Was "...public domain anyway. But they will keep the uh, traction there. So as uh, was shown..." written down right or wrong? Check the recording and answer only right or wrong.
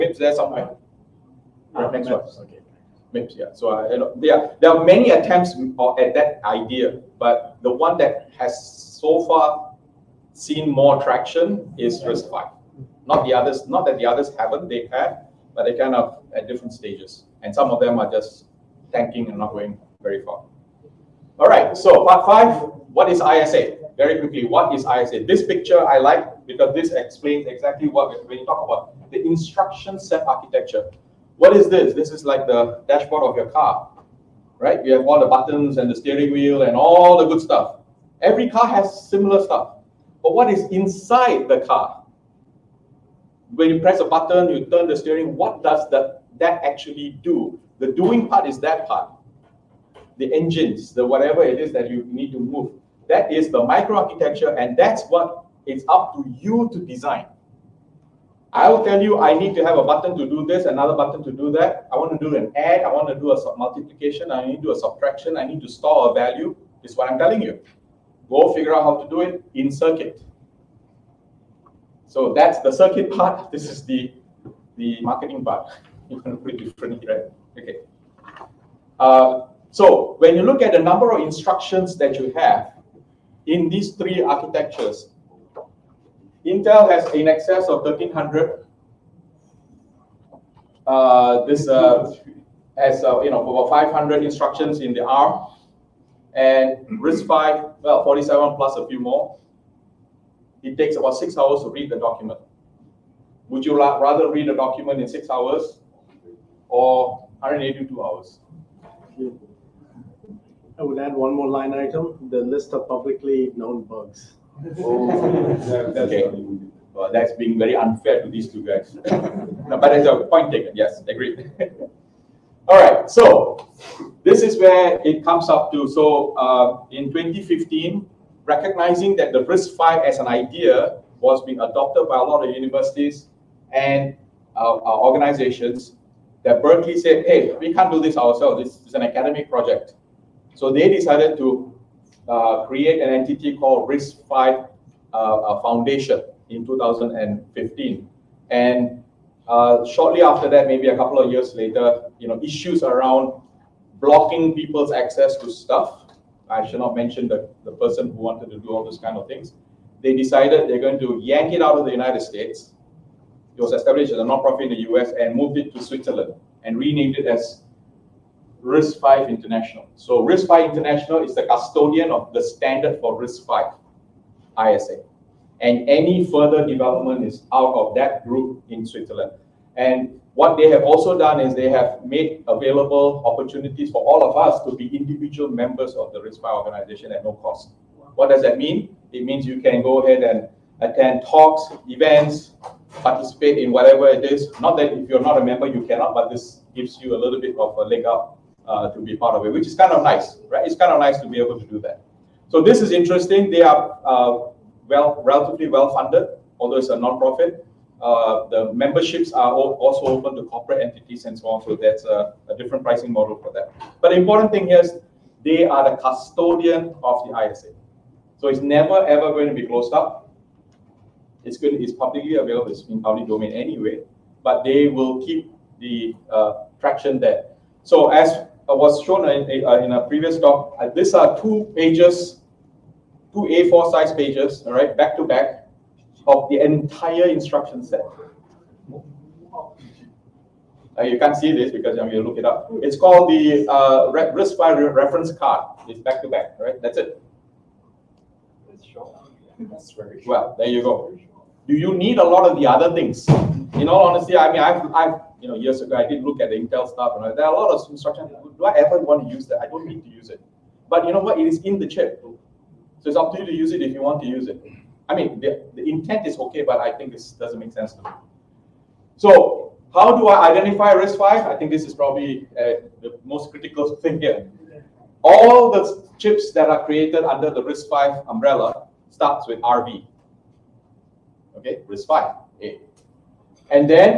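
right.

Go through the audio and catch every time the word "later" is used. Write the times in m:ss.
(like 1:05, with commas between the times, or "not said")
2:31.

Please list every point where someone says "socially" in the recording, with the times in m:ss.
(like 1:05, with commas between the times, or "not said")
not said.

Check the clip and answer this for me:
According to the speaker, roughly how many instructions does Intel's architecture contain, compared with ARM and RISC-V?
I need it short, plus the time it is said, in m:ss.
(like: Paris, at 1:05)
1,300, at 1:27.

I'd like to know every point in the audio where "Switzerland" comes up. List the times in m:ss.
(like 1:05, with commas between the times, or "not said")
2:45, 2:58.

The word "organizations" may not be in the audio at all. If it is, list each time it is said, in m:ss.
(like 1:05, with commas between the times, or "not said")
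2:14, 3:06.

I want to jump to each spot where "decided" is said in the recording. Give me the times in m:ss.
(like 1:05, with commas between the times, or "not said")
2:20, 2:40.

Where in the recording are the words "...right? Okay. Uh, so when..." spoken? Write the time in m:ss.
1:17.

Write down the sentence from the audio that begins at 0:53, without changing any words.
That is the microarchitecture, and that's what it's up to you to design.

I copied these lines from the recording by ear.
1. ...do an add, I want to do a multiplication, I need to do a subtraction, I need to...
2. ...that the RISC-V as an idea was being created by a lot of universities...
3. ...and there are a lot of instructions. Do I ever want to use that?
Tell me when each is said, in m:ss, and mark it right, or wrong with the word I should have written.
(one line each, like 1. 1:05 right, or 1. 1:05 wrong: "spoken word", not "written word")
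1. 1:02 right
2. 2:09 wrong: "adopted", not "created"
3. 4:17 right.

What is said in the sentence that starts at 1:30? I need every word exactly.
Uh, this uh, has uh, you know over 500 instructions in the ARM, and RISC-V well 47 plus a few more.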